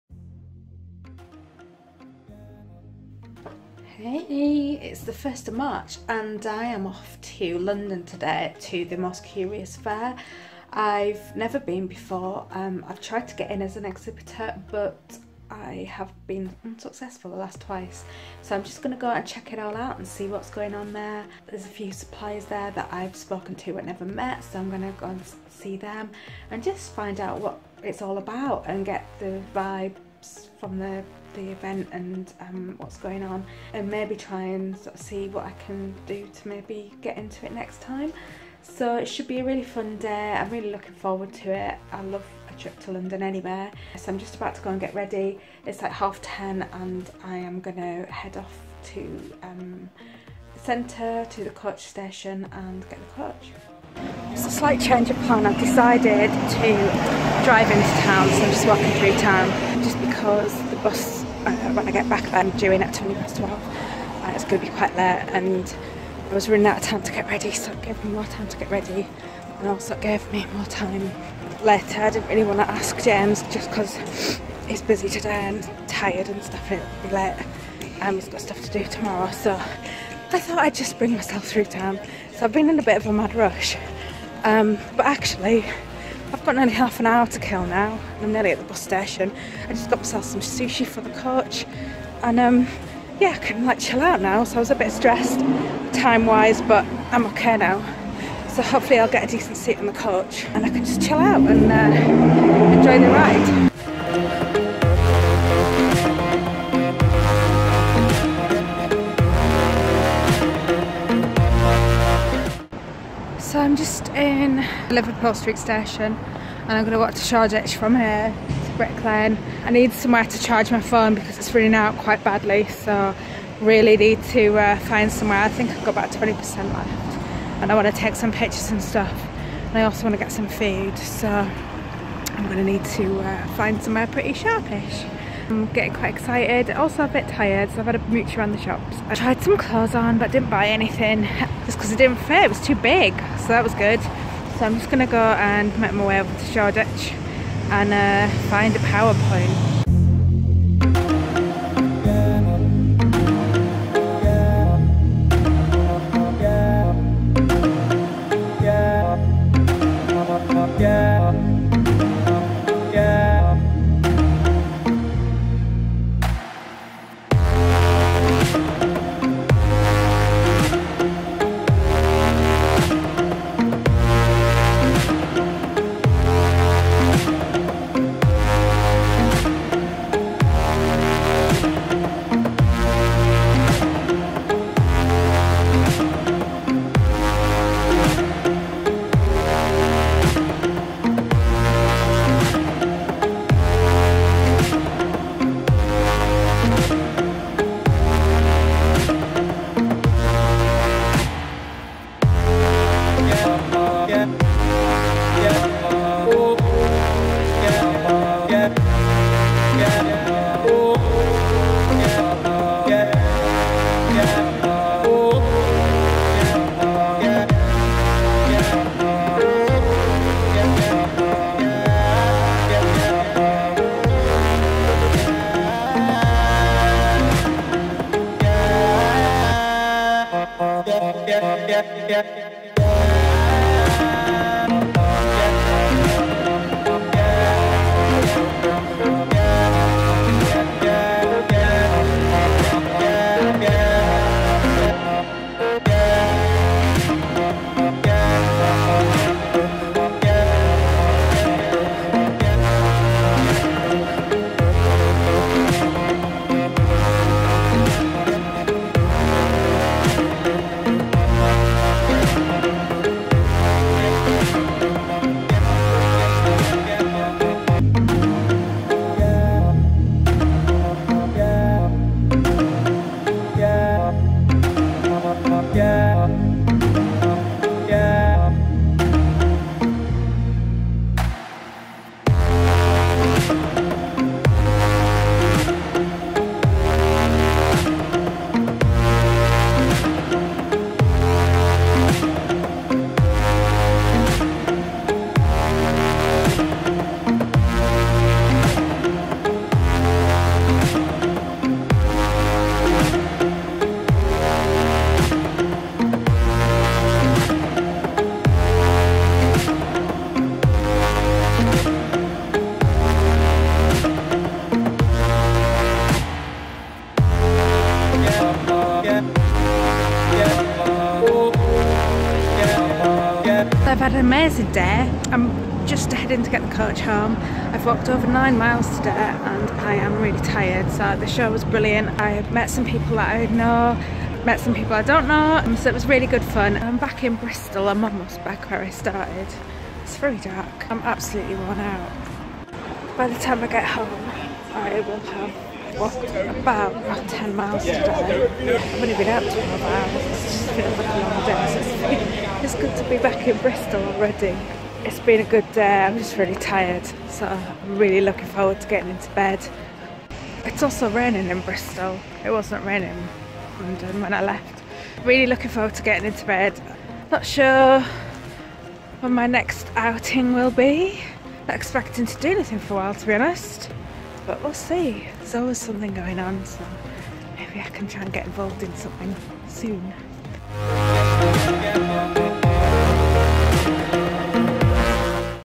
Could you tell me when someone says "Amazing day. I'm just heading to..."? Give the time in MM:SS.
05:24.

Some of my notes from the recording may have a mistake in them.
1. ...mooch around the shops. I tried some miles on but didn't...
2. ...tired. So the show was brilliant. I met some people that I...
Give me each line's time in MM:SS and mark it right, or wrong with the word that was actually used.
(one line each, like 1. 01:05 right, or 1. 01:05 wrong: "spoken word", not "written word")
1. 02:18 wrong: "clothes", not "miles"
2. 05:30 right.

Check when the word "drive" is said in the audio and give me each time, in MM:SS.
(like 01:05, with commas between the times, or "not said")
00:57.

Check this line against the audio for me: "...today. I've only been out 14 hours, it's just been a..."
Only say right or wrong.
wrong.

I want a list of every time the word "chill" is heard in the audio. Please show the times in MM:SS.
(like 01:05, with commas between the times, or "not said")
01:33, 01:40.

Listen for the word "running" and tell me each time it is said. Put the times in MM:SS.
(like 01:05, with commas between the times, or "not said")
01:06, 02:01.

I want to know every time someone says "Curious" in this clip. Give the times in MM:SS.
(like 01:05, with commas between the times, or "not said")
00:09.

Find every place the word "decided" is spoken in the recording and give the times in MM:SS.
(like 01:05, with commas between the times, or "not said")
00:55.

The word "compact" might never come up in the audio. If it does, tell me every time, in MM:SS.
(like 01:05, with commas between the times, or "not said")
not said.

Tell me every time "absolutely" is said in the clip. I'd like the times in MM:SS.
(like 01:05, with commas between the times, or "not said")
05:40.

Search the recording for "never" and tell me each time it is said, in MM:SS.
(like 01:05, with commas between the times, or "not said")
00:11, 00:23.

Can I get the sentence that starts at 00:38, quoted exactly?
So it should be a really fun day.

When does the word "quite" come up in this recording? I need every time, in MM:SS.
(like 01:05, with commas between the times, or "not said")
01:04, 02:01, 02:15.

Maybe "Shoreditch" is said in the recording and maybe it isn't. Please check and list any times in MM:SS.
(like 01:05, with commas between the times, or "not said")
01:57, 02:26.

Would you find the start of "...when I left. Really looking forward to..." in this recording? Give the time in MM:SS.
06:04.